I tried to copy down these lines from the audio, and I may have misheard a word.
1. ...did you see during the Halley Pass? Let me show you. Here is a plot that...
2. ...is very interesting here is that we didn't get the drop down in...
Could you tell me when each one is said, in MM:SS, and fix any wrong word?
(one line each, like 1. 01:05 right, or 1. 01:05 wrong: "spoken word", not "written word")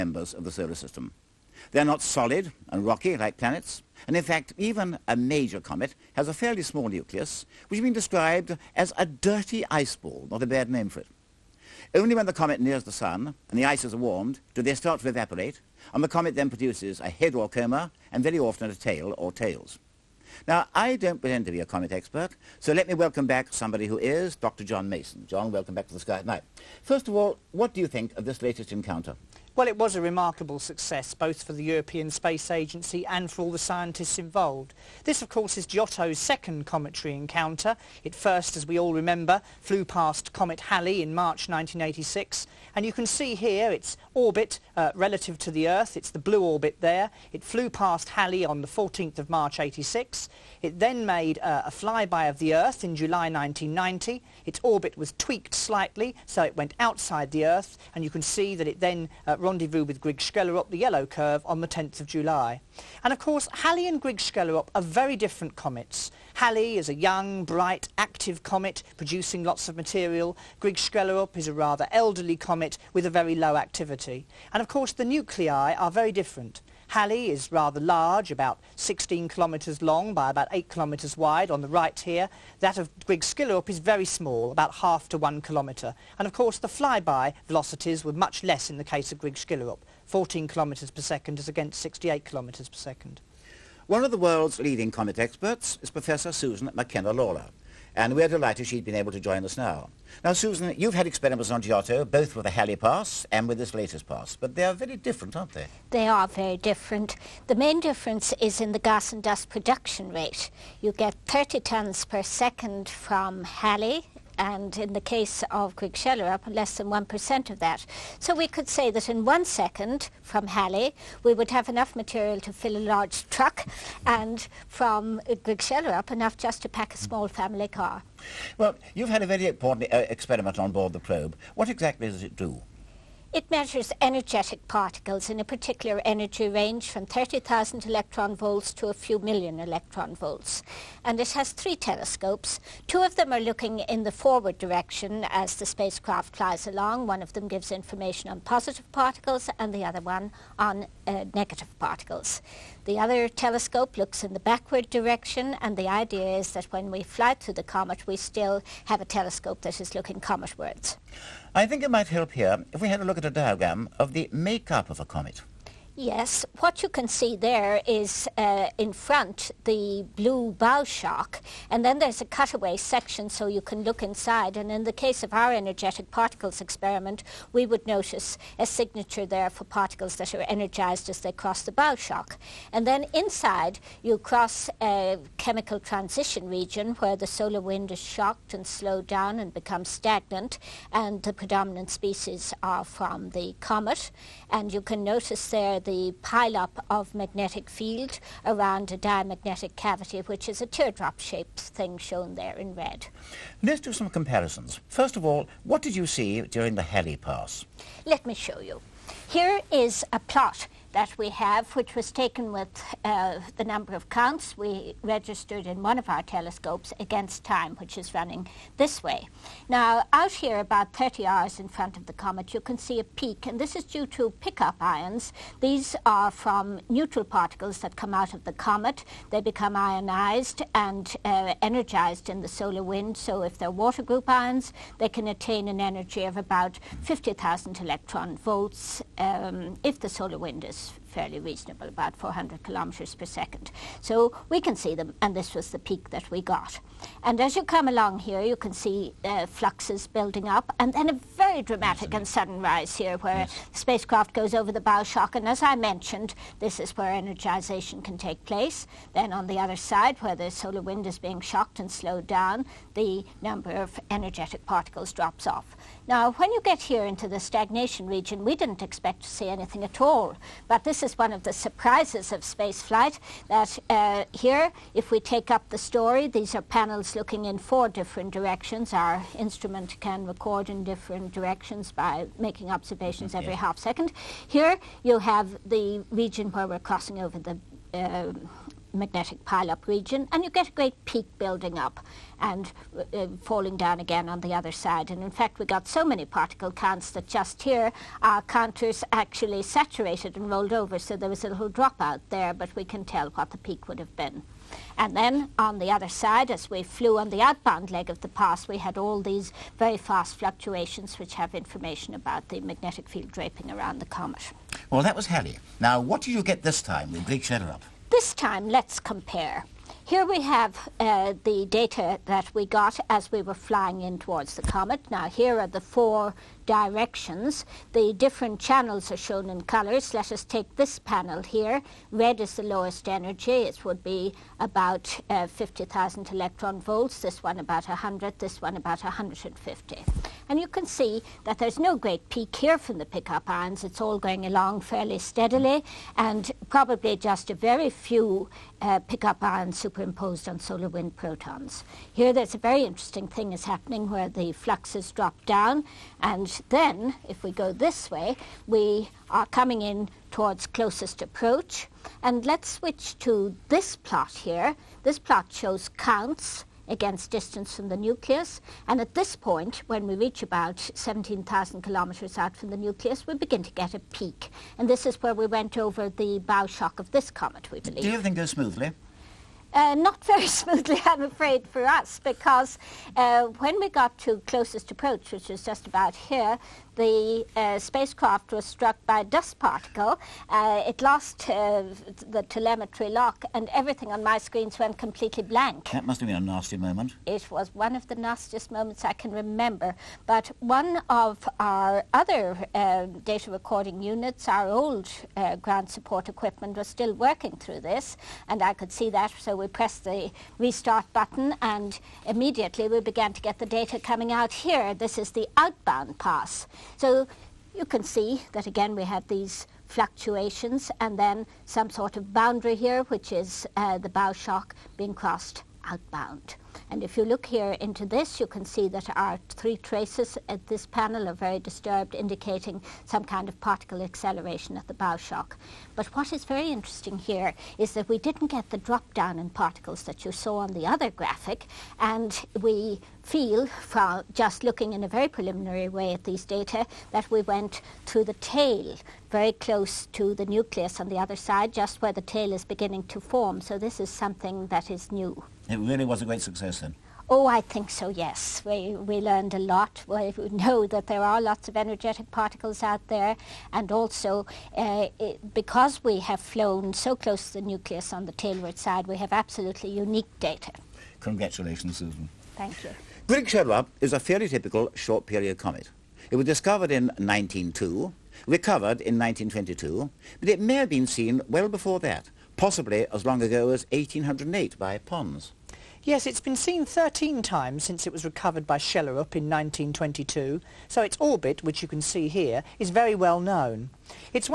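1. 03:25 right
2. 07:16 right.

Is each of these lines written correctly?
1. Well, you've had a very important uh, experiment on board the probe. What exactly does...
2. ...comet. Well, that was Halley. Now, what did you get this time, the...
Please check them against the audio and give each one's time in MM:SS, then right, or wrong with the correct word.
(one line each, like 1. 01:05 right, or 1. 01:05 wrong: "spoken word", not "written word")
1. 02:08 right
2. 05:14 right.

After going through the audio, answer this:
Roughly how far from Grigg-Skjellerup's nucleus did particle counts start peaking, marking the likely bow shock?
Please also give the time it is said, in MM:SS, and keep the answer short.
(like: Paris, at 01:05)
17,000 kilometers, at 06:10.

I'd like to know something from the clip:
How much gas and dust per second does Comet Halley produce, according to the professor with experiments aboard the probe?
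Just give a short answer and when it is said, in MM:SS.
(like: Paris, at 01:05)
30 tons, at 01:51.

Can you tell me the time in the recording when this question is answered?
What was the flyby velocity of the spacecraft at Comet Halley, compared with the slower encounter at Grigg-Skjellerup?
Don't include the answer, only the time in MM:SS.
01:31.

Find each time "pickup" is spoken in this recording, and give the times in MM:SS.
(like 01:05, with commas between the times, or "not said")
03:44, 05:43, 05:49.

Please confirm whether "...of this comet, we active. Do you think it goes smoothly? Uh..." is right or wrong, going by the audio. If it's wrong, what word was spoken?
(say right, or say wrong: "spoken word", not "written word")
wrong: "believe", not "active".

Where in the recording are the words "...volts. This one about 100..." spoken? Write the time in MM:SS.
05:36.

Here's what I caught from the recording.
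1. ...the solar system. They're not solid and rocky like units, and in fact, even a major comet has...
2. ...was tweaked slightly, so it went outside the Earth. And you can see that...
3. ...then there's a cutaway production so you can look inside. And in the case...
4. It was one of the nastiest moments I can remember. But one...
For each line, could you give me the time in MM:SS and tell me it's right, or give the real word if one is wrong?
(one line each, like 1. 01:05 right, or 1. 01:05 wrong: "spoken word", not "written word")
1. 00:00 wrong: "planets", not "units"
2. 00:54 right
3. 02:51 wrong: "section", not "production"
4. 06:37 right.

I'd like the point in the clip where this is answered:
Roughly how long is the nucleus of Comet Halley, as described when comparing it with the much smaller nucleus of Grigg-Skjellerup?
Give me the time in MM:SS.
01:18.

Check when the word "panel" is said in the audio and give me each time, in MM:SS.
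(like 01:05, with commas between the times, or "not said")
04:36, 05:30, 07:10.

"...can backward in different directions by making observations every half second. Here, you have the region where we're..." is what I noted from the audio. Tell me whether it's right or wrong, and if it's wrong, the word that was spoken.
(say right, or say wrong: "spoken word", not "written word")
wrong: "record", not "backward".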